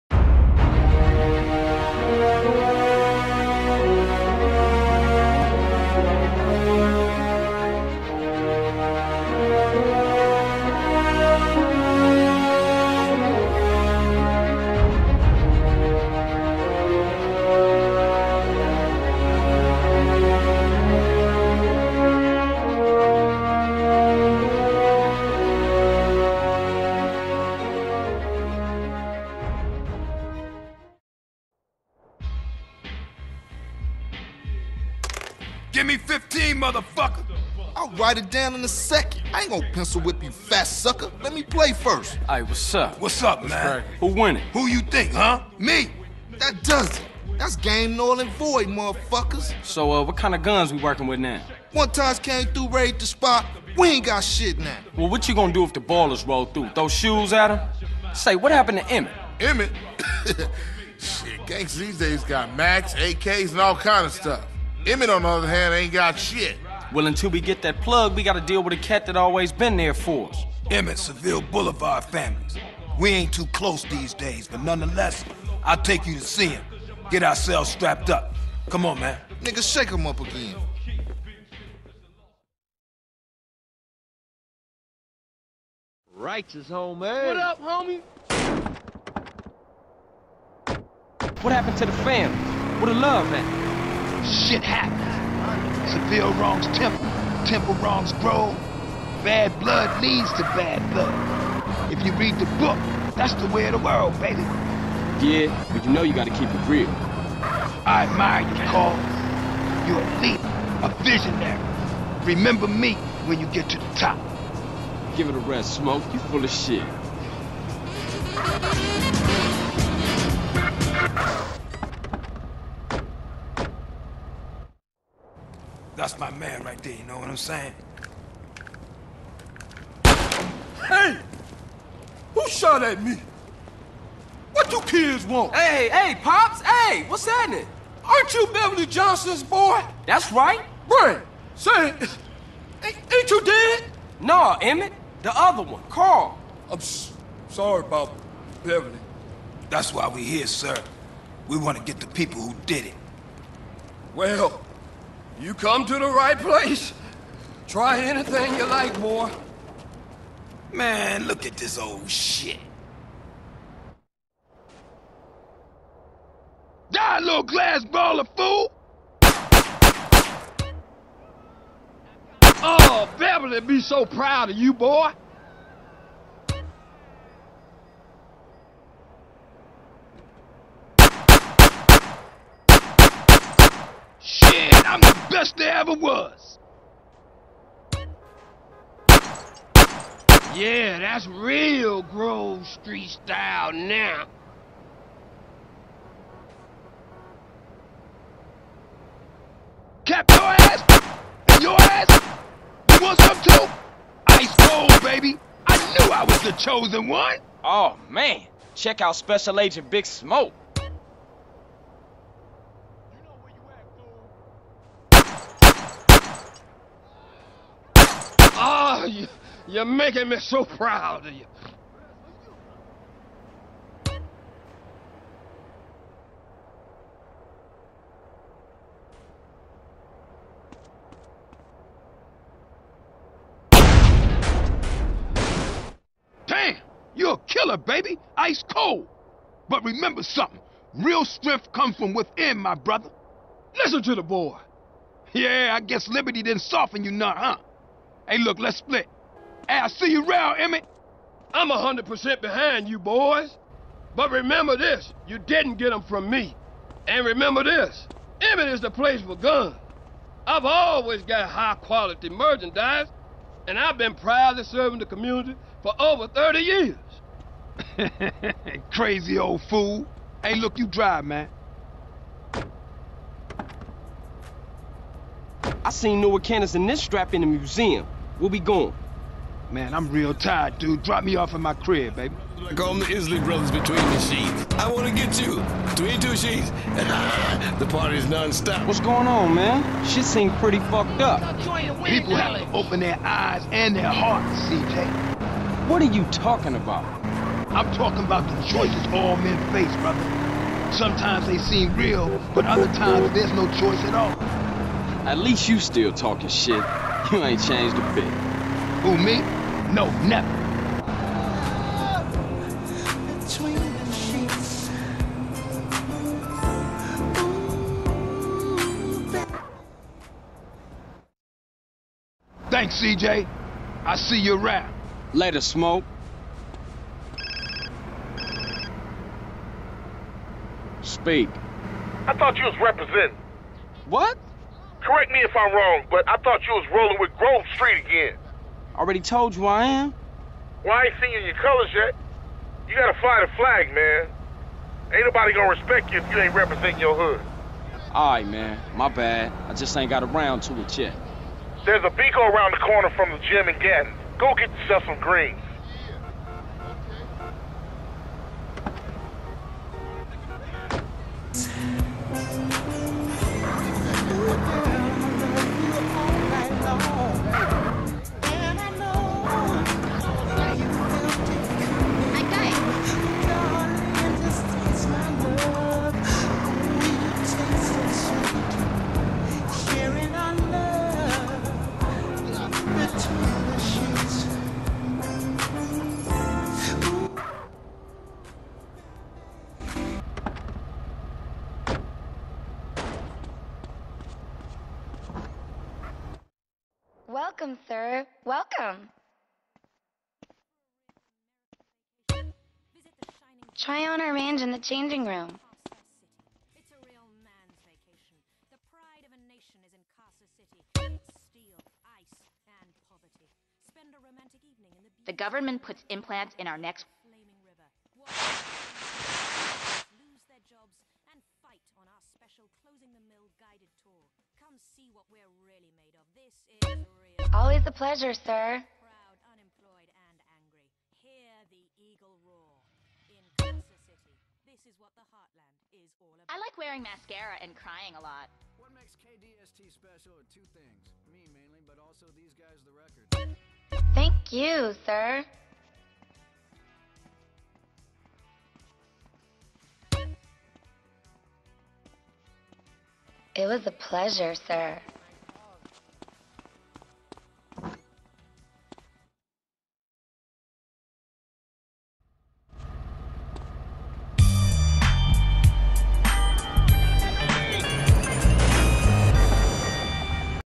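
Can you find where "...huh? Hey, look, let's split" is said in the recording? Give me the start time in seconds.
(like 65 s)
247 s.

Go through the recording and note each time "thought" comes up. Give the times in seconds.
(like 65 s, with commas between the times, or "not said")
332 s, 336 s.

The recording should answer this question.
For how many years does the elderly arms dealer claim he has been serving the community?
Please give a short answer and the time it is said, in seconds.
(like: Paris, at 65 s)
30, at 266 s.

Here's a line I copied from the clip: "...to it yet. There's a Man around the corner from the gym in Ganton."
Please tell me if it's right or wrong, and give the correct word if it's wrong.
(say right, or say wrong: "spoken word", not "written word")
wrong: "Binco", not "Man".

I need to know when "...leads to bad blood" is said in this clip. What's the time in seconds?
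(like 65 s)
100 s.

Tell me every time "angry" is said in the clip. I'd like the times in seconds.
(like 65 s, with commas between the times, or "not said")
430 s.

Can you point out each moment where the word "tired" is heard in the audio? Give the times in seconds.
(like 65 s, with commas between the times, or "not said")
280 s.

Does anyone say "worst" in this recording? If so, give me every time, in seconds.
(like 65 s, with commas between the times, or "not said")
185 s.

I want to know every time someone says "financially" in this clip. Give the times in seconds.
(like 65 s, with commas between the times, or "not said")
not said.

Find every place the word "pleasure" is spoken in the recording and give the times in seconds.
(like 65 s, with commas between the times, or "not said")
427 s, 453 s.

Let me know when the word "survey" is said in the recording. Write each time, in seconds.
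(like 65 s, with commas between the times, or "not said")
not said.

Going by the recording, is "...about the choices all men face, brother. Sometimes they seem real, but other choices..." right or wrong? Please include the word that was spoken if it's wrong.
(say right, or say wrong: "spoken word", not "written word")
wrong: "times", not "choices".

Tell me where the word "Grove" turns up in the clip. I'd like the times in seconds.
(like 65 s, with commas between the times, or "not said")
192 s, 337 s.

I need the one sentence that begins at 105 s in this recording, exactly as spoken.
Yeah, but you know you gotta keep it real.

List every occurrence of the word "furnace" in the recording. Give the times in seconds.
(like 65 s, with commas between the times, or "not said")
not said.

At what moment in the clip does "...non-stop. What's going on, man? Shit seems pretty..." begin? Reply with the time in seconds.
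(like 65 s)
288 s.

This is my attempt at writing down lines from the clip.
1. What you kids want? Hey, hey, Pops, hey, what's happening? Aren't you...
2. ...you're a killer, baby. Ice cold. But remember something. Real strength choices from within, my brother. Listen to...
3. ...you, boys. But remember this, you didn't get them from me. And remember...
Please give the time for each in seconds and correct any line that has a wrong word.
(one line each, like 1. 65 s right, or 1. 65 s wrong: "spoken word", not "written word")
1. 134 s right
2. 237 s wrong: "comes", not "choices"
3. 252 s right.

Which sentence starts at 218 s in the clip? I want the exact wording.
Oh, you, you're making me so proud of you.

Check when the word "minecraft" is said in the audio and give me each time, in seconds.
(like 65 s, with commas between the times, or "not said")
not said.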